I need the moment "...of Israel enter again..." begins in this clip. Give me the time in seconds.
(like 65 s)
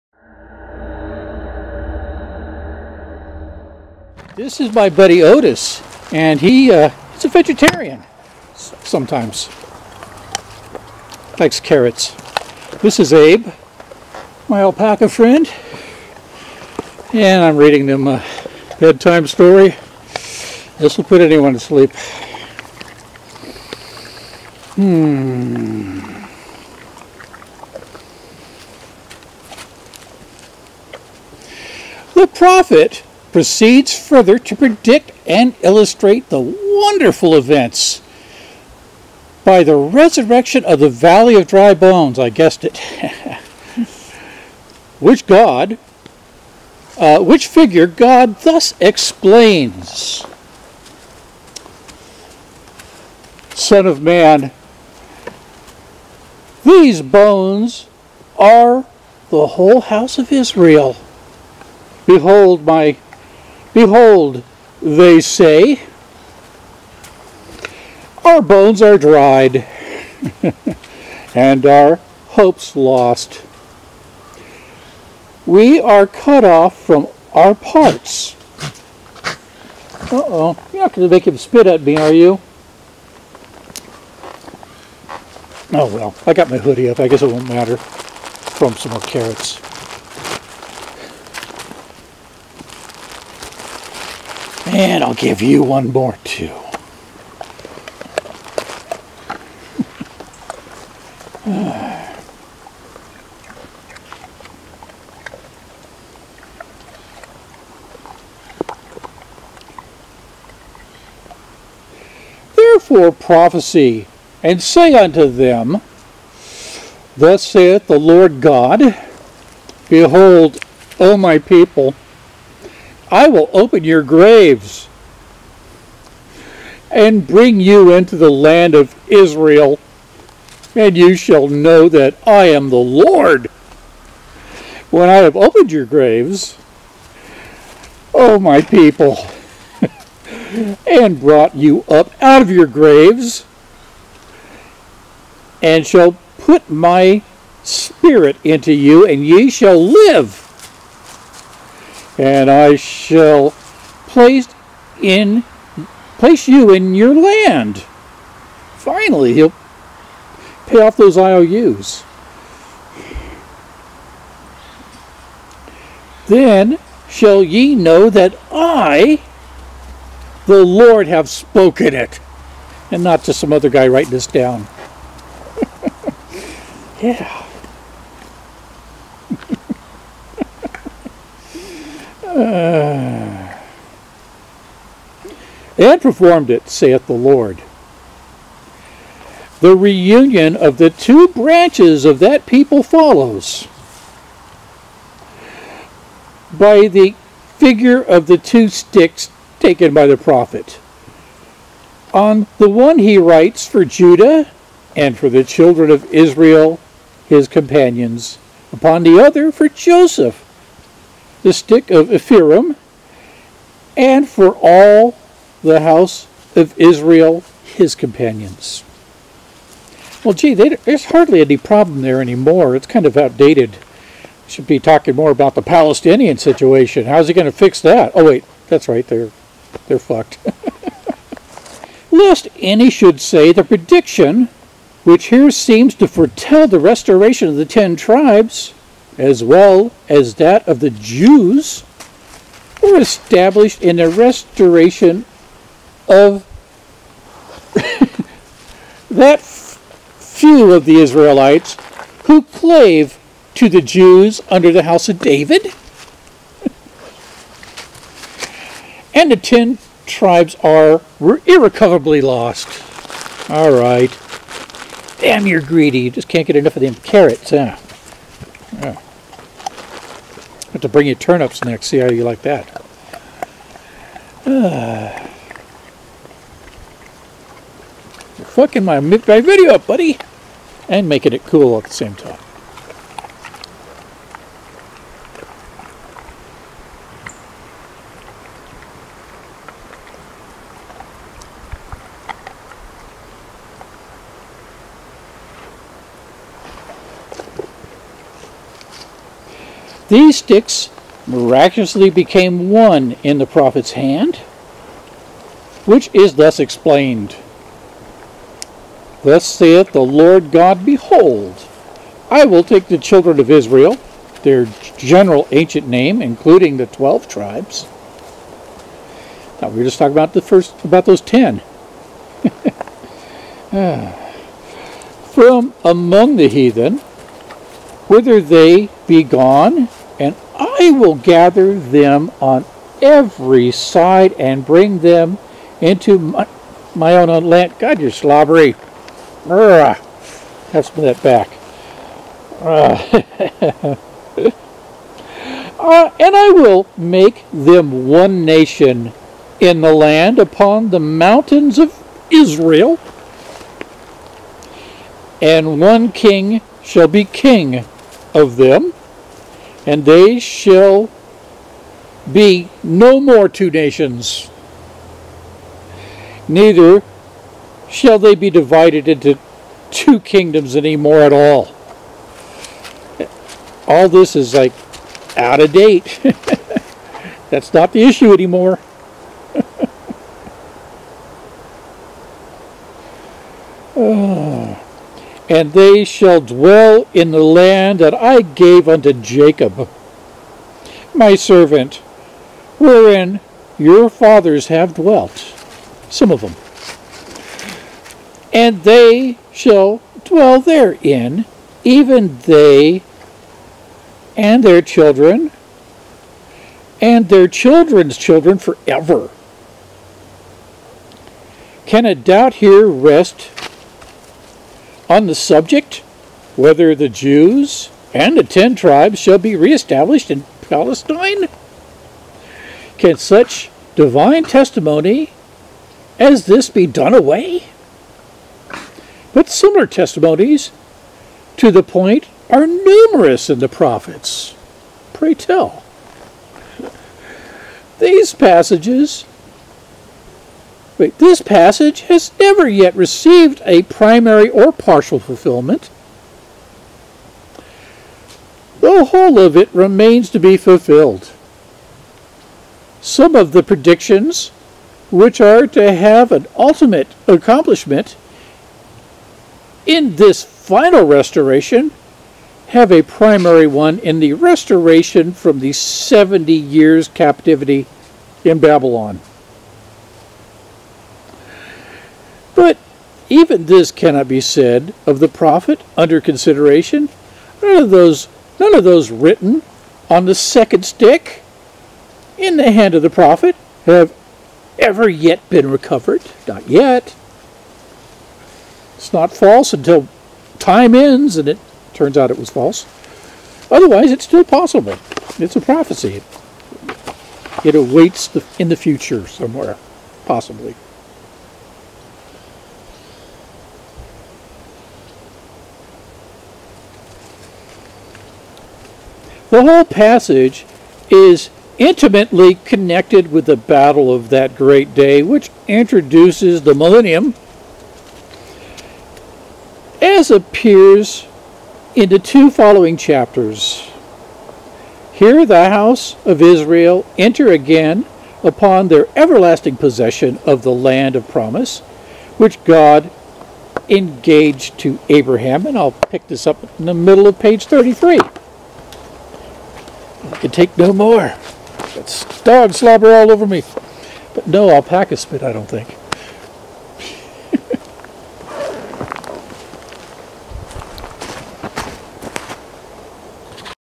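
526 s.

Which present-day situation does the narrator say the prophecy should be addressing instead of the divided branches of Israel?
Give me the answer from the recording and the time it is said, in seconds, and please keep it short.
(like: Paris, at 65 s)
The Palestinian situation, at 225 s.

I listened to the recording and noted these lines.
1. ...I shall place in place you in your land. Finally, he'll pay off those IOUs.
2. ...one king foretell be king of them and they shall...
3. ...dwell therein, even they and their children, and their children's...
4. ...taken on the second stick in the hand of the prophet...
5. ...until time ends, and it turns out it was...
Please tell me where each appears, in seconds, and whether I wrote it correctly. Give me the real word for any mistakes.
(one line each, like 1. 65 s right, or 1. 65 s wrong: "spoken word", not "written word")
1. 152 s right
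2. 355 s wrong: "shall", not "foretell"
3. 400 s right
4. 479 s wrong: "written", not "taken"
5. 489 s right.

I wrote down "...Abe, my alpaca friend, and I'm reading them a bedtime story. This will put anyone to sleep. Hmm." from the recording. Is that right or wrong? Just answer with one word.
right.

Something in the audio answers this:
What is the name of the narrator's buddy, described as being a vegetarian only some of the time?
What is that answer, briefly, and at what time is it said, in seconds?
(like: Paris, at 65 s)
Otis, at 5 s.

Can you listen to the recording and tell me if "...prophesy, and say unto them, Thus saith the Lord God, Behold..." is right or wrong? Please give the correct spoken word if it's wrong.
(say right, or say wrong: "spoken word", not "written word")
right.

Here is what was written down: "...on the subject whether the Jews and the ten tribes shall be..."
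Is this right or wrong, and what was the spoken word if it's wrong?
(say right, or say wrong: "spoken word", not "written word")
right.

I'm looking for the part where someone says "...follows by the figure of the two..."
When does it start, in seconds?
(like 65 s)
192 s.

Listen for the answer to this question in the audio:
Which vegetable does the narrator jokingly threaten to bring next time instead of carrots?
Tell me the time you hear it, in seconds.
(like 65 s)
271 s.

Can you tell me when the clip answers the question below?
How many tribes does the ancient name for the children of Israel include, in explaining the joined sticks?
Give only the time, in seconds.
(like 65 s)
316 s.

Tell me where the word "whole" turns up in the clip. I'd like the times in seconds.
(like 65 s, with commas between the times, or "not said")
59 s, 449 s, 509 s.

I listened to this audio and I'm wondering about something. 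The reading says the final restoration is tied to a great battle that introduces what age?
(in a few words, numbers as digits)
The millennium.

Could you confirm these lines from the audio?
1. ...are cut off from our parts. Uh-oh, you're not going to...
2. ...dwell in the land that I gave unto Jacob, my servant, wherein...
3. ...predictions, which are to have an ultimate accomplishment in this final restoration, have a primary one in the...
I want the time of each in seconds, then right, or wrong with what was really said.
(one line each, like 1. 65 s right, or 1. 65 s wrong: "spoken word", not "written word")
1. 75 s right
2. 386 s right
3. 453 s right.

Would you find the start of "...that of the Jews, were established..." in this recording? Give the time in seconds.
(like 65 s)
240 s.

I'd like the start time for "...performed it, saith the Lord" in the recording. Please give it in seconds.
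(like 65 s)
186 s.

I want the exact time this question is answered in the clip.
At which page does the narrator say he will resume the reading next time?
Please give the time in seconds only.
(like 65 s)
537 s.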